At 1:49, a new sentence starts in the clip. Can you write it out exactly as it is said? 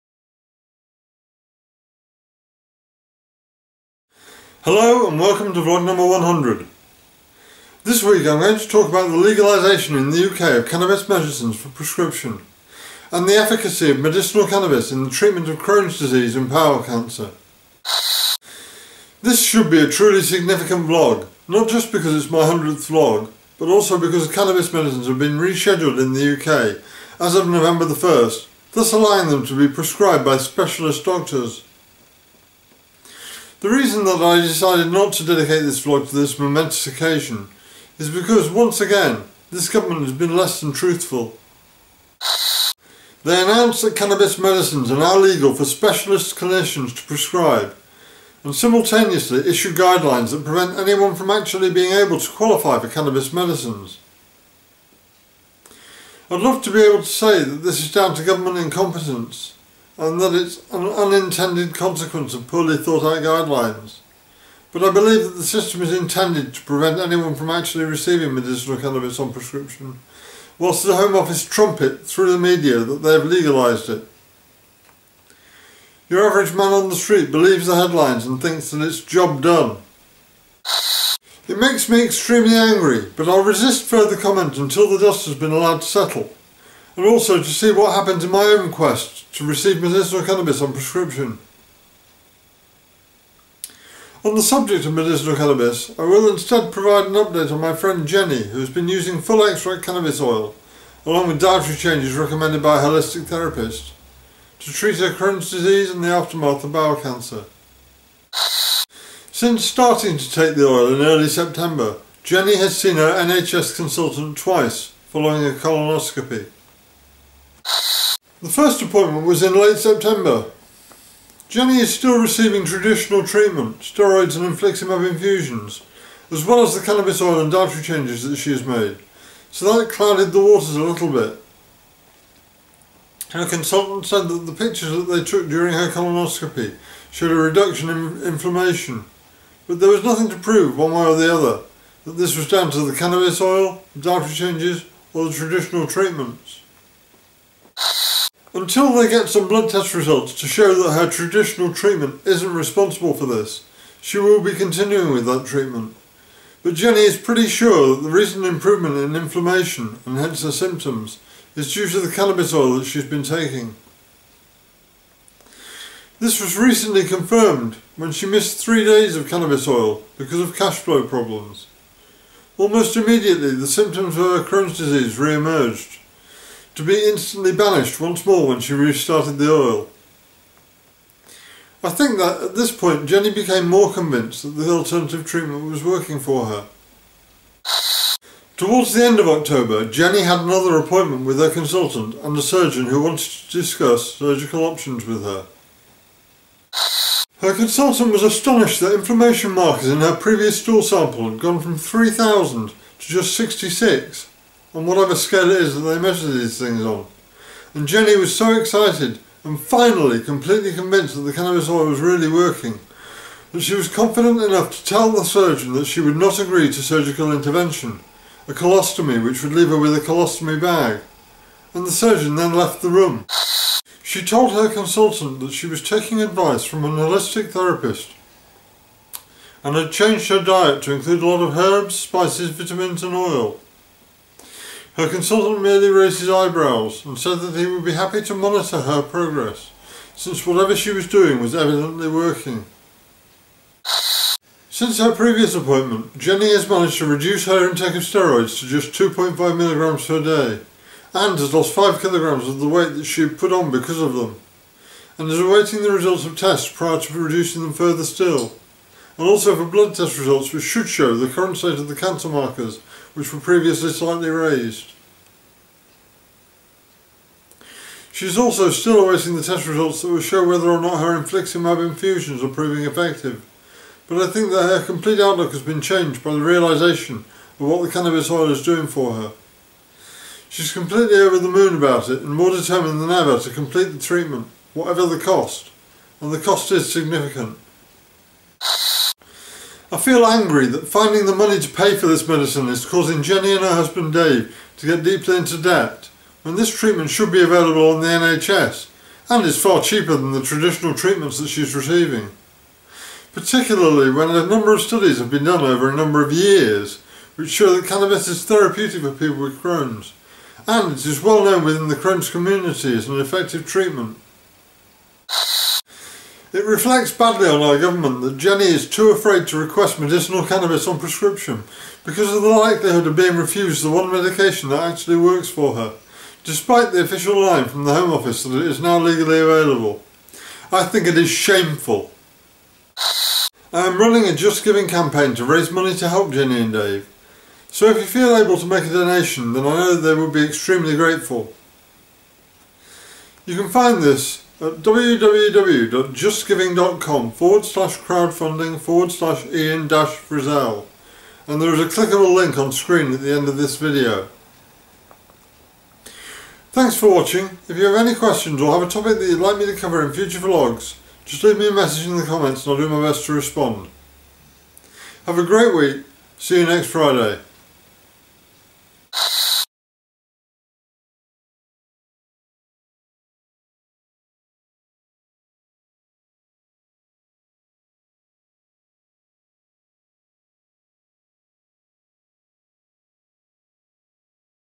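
Since starting to take the oil in early September, Jenny has seen her NHS consultant twice, following a colonoscopy.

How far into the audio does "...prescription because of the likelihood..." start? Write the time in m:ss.
5:20.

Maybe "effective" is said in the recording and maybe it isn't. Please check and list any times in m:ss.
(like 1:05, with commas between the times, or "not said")
4:32, 5:13.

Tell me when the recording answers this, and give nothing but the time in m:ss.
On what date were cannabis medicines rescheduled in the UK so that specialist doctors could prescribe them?
0:27.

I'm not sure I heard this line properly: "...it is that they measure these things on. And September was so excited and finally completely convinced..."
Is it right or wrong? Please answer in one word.
wrong.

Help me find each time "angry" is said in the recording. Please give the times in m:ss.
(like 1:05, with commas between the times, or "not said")
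1:22, 4:50.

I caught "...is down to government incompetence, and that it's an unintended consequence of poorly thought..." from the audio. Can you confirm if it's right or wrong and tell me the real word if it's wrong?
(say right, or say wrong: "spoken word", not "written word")
right.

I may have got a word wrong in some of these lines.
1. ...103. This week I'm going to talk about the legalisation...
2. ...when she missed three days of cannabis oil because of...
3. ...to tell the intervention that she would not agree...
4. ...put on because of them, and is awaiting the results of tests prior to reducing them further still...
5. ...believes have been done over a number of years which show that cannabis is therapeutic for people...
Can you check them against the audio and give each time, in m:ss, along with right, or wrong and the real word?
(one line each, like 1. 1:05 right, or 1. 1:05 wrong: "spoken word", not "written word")
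1. 0:06 wrong: "100", not "103"
2. 2:47 right
3. 3:34 wrong: "surgeon", not "intervention"
4. 4:13 right
5. 5:04 wrong: "studies", not "believes".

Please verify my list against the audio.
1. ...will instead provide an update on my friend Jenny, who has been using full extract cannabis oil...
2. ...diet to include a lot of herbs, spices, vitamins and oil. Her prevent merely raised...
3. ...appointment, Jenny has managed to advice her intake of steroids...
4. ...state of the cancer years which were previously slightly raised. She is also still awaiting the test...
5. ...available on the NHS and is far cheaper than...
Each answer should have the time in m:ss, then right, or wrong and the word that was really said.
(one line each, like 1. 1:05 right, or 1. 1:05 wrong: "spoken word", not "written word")
1. 1:36 right
2. 3:50 wrong: "consultant", not "prevent"
3. 4:05 wrong: "reduce", not "advice"
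4. 4:21 wrong: "markers", not "years"
5. 4:57 right.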